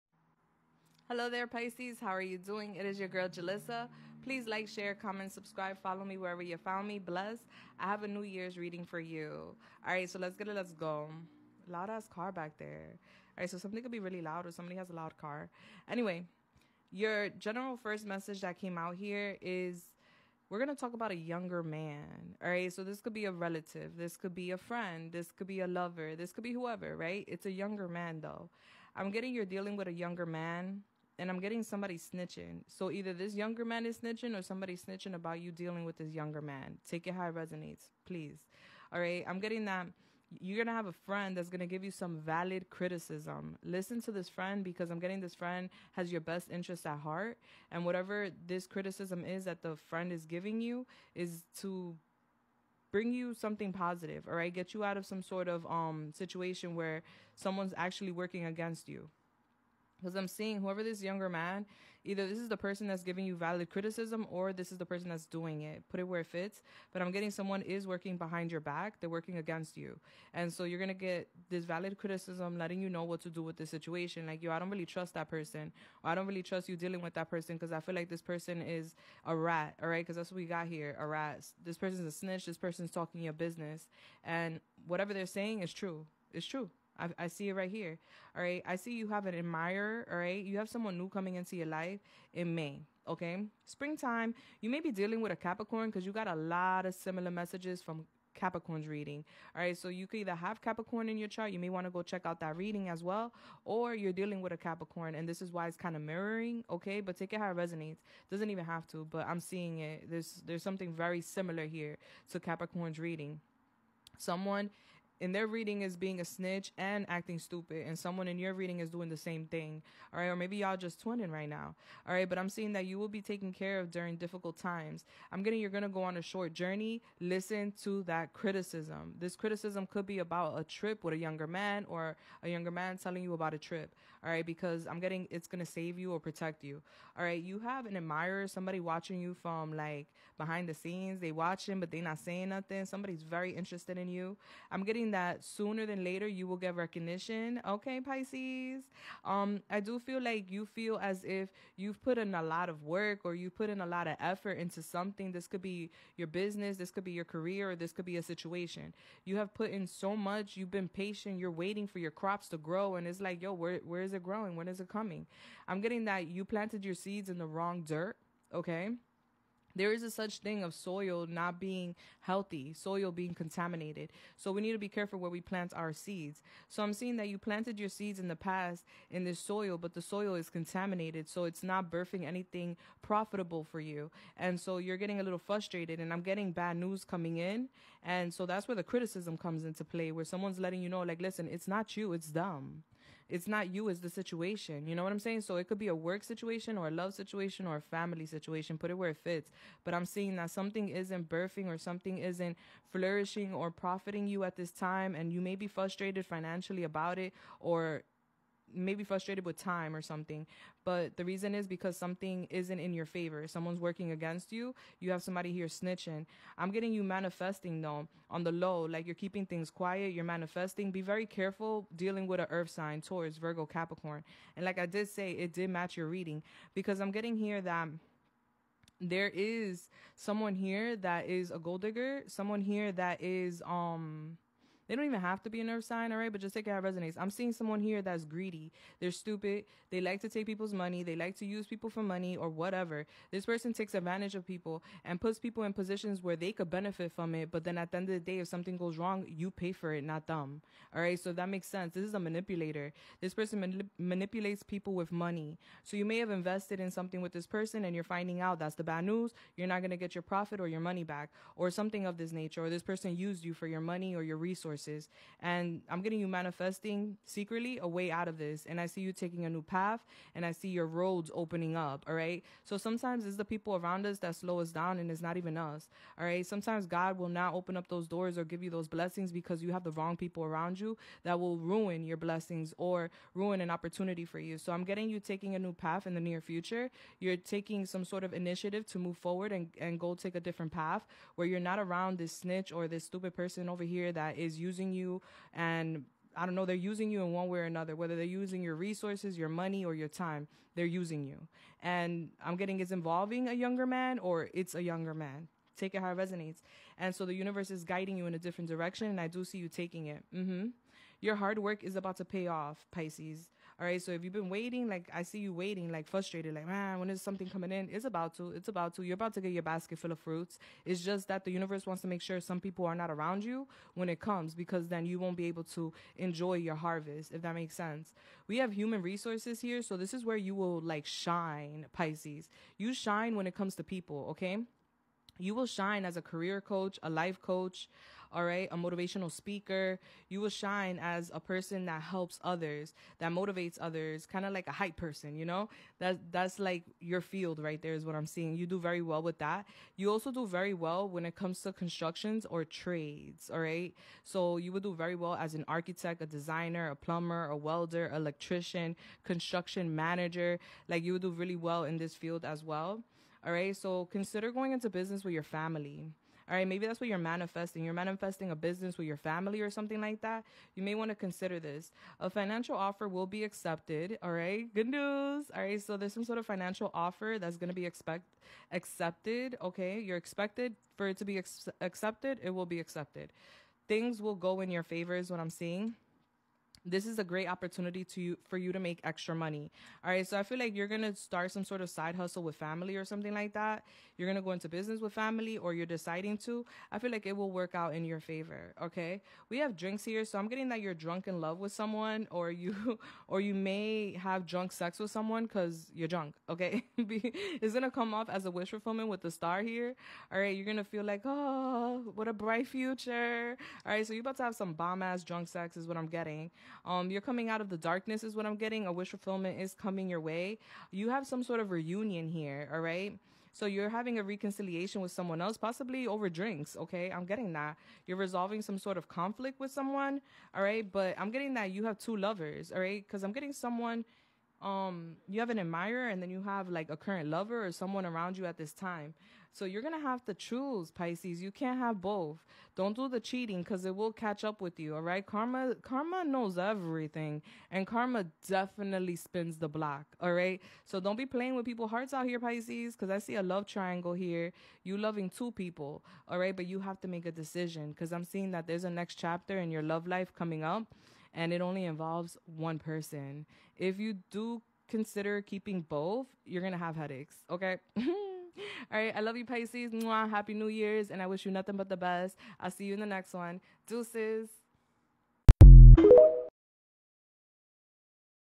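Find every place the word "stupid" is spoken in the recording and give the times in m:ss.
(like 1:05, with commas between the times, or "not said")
1:57, 3:59, 4:53.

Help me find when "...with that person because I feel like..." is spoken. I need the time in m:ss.
1:17.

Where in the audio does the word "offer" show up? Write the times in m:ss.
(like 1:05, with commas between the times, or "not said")
6:12, 6:16.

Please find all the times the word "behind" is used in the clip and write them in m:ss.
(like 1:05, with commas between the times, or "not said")
1:08, 2:20.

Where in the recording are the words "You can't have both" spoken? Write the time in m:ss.
7:21.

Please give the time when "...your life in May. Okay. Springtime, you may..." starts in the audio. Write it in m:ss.
1:31.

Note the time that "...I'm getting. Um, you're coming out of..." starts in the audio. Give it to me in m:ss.
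6:55.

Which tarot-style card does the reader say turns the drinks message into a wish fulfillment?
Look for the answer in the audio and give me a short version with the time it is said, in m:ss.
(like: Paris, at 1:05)
the star, at 6:49.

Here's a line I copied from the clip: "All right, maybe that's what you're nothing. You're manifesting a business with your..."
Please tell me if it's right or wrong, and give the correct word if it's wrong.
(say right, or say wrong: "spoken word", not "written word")
wrong: "manifesting", not "nothing".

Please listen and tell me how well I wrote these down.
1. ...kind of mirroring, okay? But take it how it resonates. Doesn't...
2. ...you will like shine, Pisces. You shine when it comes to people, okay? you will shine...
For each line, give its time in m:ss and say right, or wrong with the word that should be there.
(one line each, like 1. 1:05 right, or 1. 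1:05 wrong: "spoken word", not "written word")
1. 1:45 right
2. 5:30 right.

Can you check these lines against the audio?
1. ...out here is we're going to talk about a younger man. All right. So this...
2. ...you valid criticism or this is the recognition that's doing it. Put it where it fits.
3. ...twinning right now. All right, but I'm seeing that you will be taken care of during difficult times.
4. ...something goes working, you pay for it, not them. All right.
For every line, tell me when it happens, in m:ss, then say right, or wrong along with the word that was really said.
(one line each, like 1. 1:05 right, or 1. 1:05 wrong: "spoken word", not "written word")
1. 0:18 right
2. 1:03 wrong: "person", not "recognition"
3. 2:01 right
4. 4:08 wrong: "wrong", not "working".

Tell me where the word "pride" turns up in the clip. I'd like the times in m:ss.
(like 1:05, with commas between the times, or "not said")
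not said.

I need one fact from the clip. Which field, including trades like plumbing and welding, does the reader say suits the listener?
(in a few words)
construction.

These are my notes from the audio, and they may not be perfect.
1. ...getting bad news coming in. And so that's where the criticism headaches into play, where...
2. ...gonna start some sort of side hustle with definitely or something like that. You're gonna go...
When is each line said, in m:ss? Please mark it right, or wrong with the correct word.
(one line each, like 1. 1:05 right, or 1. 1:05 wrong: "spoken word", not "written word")
1. 3:06 wrong: "comes", not "headaches"
2. 6:30 wrong: "family", not "definitely".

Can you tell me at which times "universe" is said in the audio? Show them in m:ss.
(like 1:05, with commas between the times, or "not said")
5:07, 5:21.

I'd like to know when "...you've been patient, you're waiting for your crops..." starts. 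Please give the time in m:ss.
2:40.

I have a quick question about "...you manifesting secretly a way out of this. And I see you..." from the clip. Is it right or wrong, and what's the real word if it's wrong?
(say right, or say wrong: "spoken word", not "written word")
right.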